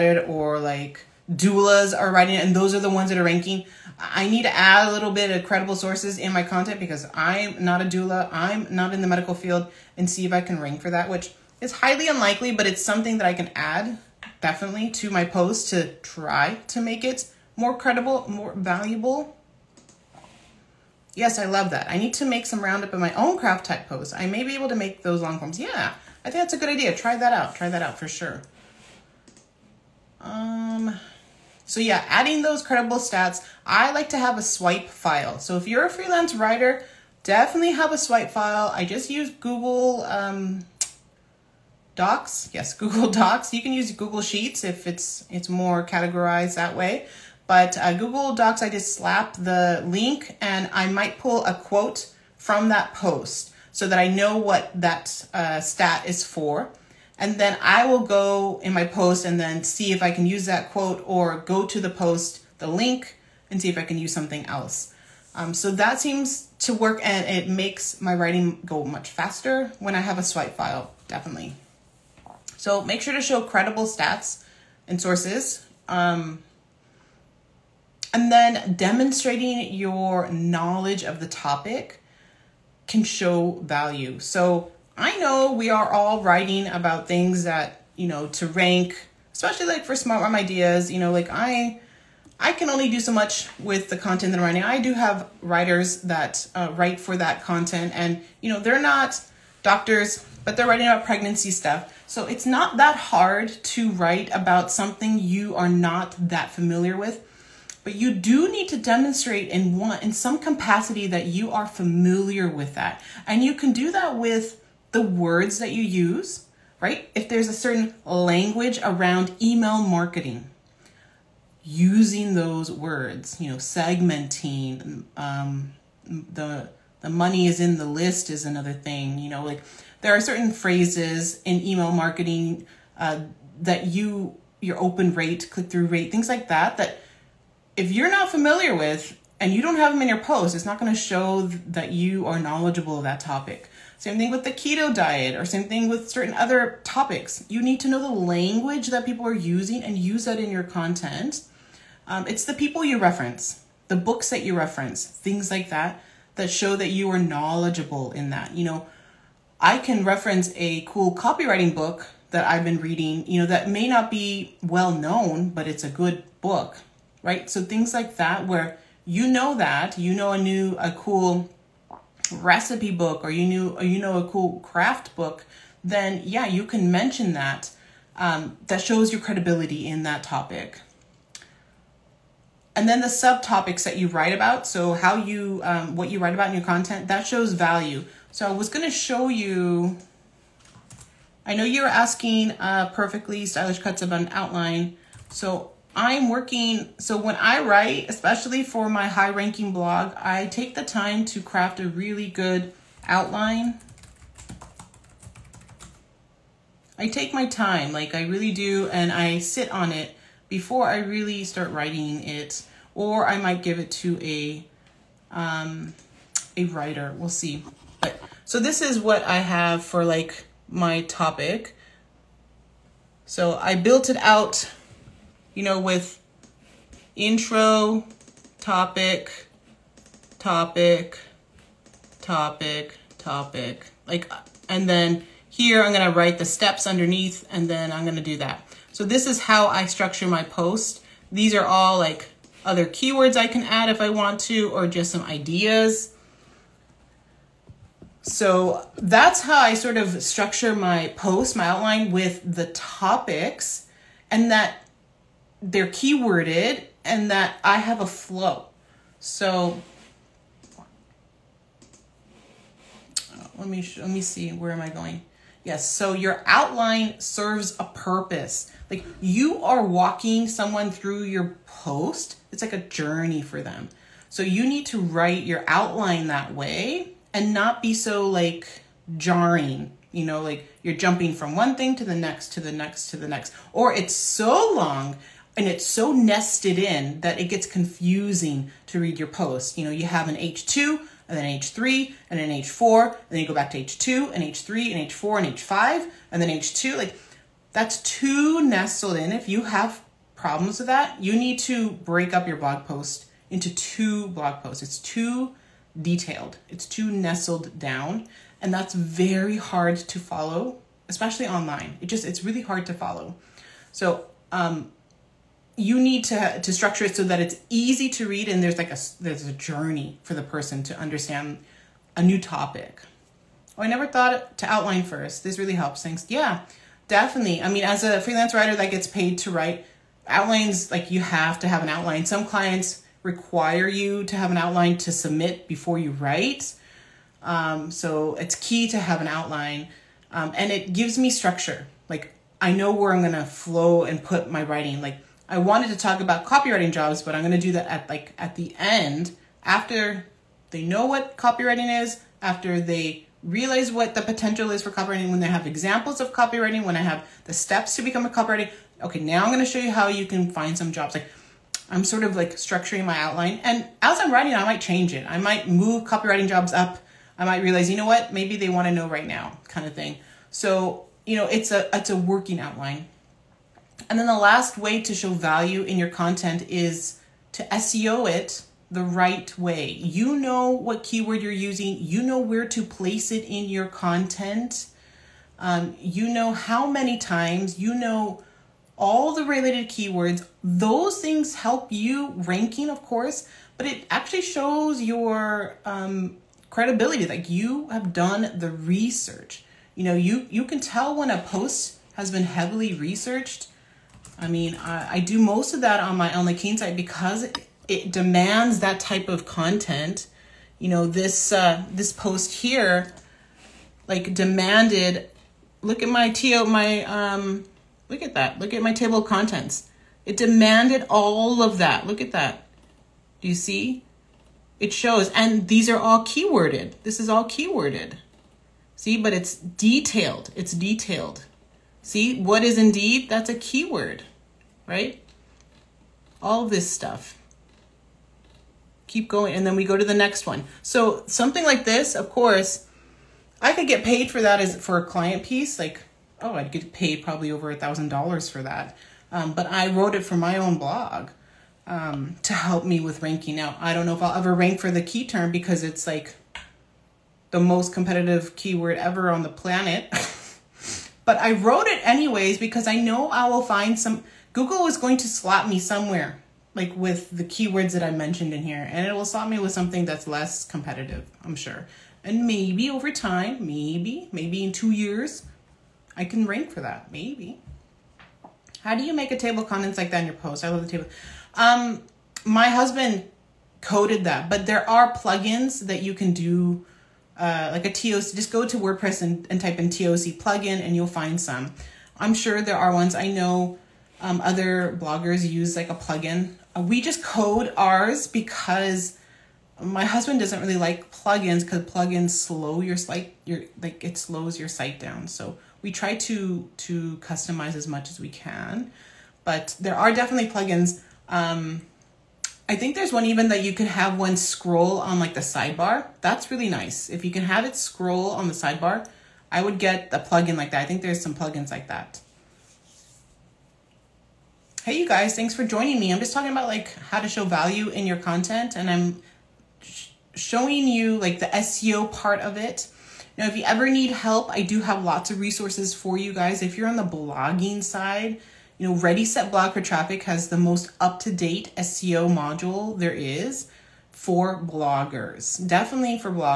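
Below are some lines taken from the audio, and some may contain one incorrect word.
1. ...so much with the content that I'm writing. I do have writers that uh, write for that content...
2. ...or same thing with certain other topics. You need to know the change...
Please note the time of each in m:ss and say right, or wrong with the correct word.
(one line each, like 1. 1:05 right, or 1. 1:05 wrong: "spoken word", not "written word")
1. 1:32 right
2. 2:25 wrong: "language", not "change".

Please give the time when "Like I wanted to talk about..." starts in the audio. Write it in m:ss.
5:45.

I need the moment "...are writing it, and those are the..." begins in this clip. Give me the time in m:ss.
0:01.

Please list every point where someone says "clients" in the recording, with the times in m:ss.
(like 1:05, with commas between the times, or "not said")
5:32, 7:25.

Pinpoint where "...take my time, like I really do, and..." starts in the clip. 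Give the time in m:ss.
3:27.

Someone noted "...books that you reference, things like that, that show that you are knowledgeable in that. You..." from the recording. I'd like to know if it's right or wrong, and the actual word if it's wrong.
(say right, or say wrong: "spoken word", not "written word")
right.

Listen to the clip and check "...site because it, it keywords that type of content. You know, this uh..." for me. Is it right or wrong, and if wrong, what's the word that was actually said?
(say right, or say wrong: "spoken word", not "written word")
wrong: "demands", not "keywords".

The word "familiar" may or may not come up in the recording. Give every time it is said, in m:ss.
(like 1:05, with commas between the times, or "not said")
1:46, 1:51, 2:18.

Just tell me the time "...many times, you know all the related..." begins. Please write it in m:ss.
6:26.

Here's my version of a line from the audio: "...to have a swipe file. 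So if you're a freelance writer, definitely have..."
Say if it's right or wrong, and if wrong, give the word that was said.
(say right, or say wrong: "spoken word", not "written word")
right.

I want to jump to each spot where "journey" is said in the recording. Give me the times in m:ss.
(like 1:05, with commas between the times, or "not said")
4:32, 5:19.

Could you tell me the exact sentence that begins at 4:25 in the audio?
Yes, so your outline serves a purpose.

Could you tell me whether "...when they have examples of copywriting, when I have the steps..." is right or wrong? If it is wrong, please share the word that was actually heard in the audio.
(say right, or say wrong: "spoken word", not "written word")
right.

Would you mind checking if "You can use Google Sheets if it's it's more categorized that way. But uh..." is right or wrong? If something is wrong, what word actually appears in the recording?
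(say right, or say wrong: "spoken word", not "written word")
right.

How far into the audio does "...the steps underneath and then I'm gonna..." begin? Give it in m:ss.
3:56.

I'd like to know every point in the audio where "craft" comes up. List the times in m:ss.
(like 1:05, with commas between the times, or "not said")
0:23, 2:54, 3:21.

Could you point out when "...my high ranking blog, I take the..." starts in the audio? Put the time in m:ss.
3:18.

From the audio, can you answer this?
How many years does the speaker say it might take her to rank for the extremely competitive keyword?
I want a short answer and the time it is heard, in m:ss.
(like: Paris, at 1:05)
2, at 7:54.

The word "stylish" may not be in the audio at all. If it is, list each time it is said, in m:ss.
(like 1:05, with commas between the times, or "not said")
3:13.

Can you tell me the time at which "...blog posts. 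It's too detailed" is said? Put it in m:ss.
5:04.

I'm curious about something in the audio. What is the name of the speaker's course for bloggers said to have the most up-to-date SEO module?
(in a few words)
Ready Set Blog for Traffic.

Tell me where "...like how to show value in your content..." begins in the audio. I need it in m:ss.
8:46.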